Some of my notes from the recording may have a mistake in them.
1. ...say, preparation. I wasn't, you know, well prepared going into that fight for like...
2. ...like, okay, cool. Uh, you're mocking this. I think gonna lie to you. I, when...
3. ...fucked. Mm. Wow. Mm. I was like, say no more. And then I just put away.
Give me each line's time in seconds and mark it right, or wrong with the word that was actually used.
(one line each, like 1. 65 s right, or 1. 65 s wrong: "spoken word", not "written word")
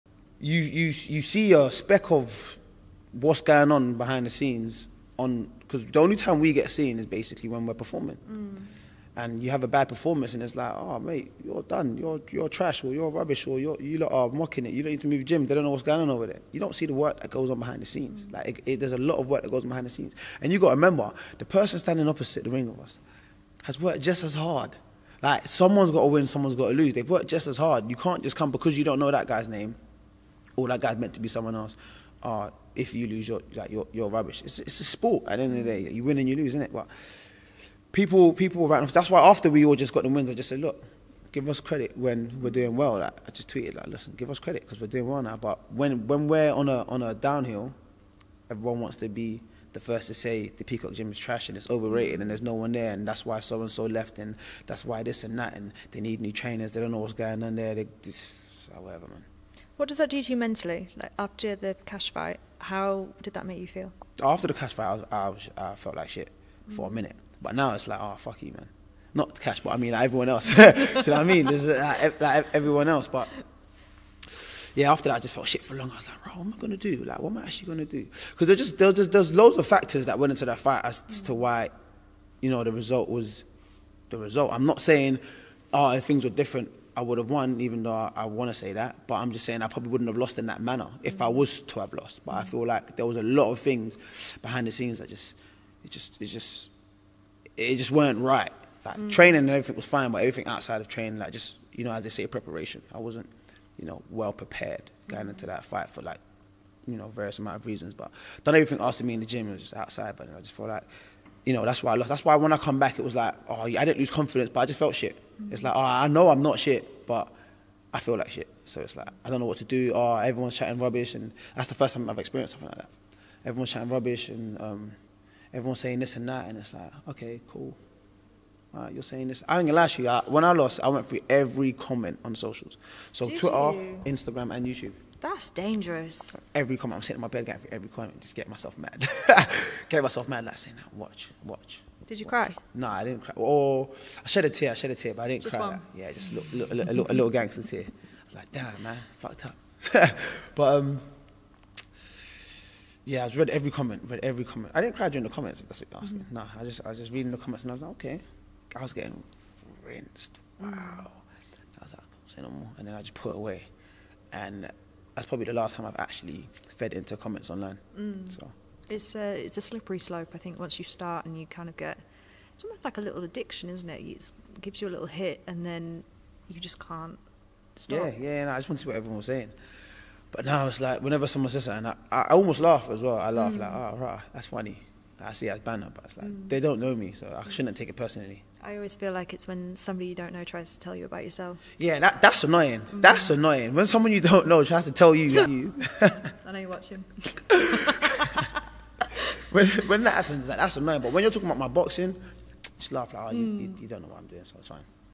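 1. 102 s right
2. 126 s wrong: "saying", not "mocking"
3. 159 s wrong: "rinsed", not "fucked".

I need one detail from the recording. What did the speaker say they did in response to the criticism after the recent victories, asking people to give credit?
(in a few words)
tweeted.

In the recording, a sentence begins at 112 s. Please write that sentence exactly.
That's why when I come back, it was like, oh, I didn't lose confidence, but I just felt shit.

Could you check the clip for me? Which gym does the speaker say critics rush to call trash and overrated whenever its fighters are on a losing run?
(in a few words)
Peacock Gym.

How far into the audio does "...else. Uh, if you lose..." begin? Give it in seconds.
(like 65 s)
31 s.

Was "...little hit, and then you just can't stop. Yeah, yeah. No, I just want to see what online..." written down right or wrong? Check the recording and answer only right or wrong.
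wrong.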